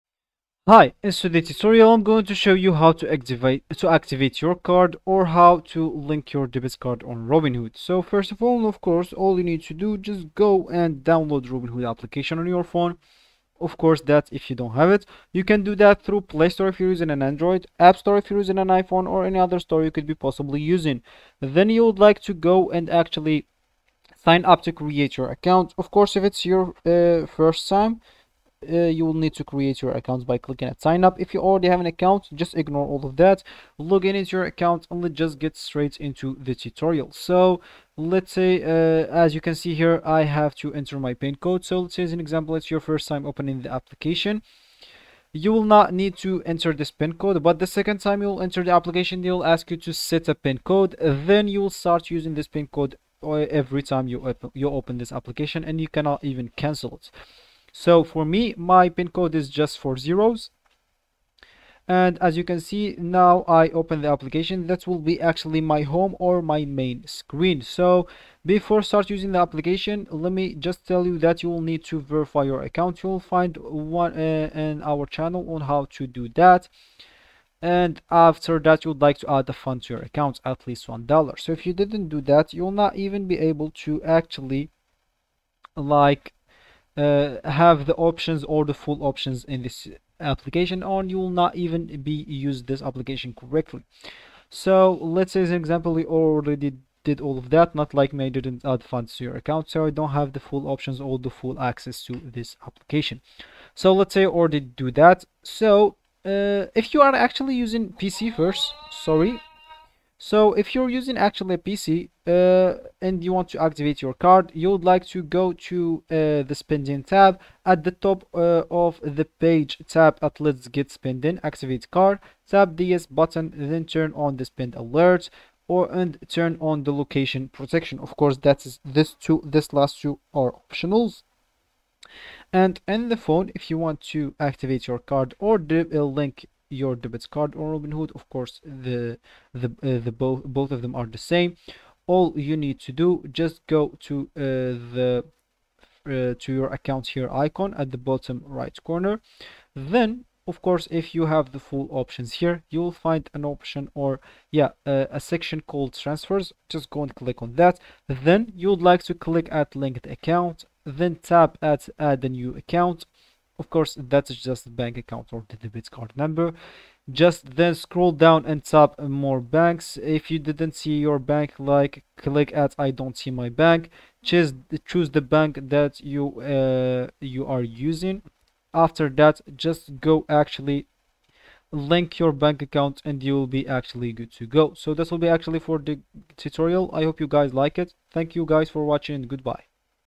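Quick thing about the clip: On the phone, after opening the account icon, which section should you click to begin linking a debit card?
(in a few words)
Transfers.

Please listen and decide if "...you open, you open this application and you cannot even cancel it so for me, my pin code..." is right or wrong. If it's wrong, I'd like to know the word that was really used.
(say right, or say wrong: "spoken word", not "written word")
right.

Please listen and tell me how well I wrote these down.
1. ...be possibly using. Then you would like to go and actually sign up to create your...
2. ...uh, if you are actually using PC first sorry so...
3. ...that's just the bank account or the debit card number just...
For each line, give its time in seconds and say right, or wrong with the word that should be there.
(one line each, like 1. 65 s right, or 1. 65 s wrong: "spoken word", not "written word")
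1. 20 s right
2. 106 s right
3. 164 s right.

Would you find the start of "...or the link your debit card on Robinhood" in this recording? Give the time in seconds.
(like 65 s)
135 s.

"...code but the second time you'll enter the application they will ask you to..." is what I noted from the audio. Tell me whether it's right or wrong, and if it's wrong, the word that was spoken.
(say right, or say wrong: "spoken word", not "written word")
right.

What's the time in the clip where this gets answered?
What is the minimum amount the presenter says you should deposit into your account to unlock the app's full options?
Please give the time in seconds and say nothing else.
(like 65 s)
80 s.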